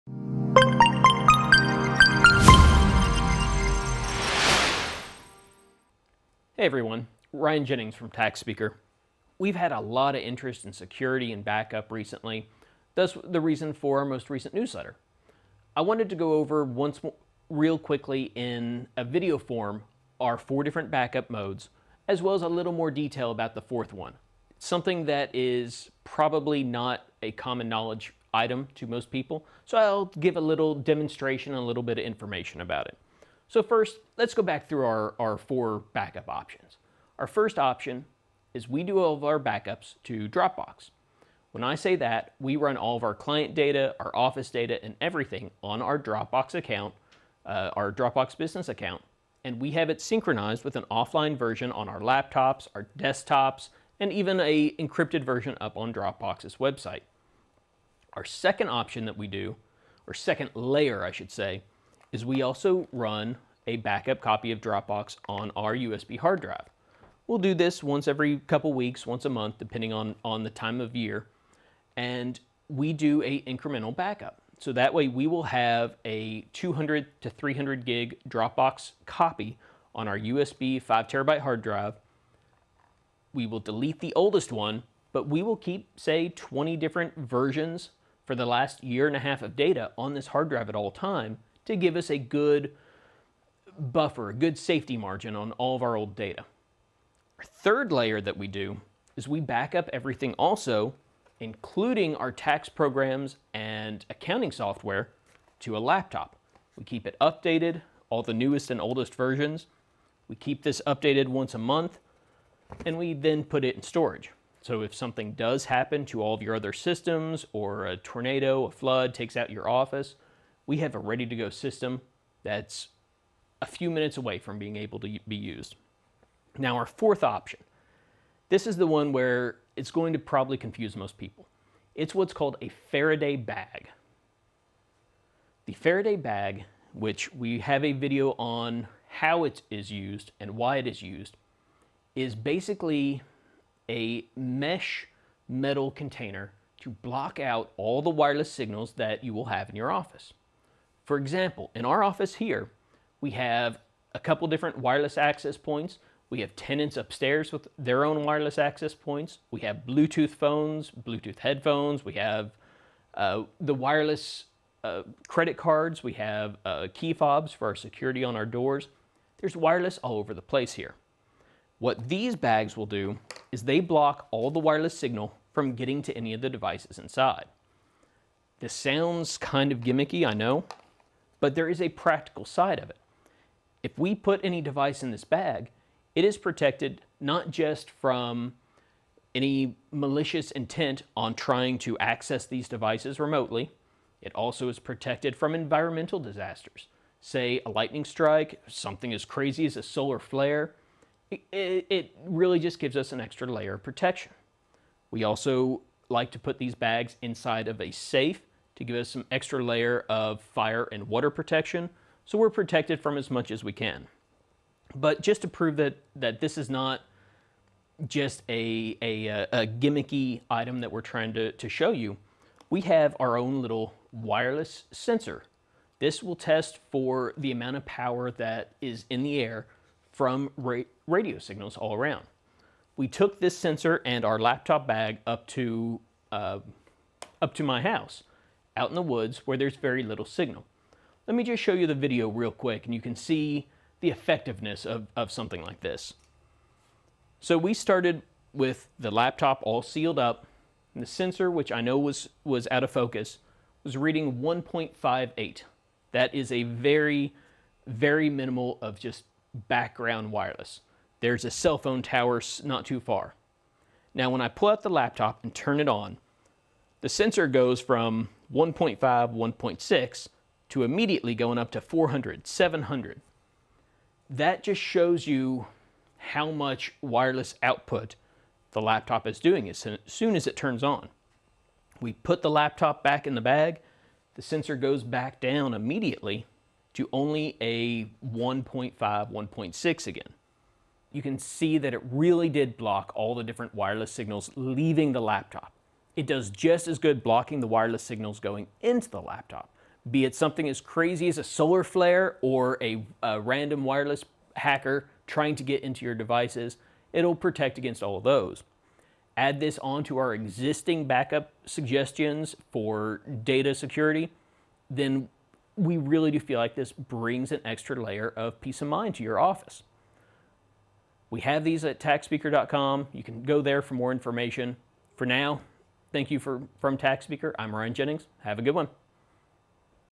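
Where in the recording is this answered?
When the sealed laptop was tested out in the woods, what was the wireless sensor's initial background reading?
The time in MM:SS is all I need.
04:14.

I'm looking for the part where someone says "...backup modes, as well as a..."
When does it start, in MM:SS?
00:20.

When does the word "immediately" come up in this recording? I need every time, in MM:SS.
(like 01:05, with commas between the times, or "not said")
04:30, 04:45.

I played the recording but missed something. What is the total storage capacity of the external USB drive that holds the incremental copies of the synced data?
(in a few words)
5 terabytes.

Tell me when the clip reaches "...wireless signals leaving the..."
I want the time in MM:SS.
04:53.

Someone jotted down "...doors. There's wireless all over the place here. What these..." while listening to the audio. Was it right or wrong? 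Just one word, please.
right.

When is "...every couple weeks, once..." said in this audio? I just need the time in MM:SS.
01:08.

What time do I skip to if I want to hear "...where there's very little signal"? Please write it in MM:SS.
03:59.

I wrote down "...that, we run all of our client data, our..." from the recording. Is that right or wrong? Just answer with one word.
right.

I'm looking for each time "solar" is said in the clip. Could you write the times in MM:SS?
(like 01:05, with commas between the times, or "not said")
03:19, 05:01.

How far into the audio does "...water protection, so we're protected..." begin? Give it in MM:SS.
03:31.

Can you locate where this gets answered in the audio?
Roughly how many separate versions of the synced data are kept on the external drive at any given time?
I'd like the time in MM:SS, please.
01:26.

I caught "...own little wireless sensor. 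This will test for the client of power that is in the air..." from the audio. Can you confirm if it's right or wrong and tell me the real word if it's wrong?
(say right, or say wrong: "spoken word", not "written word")
wrong: "amount", not "client".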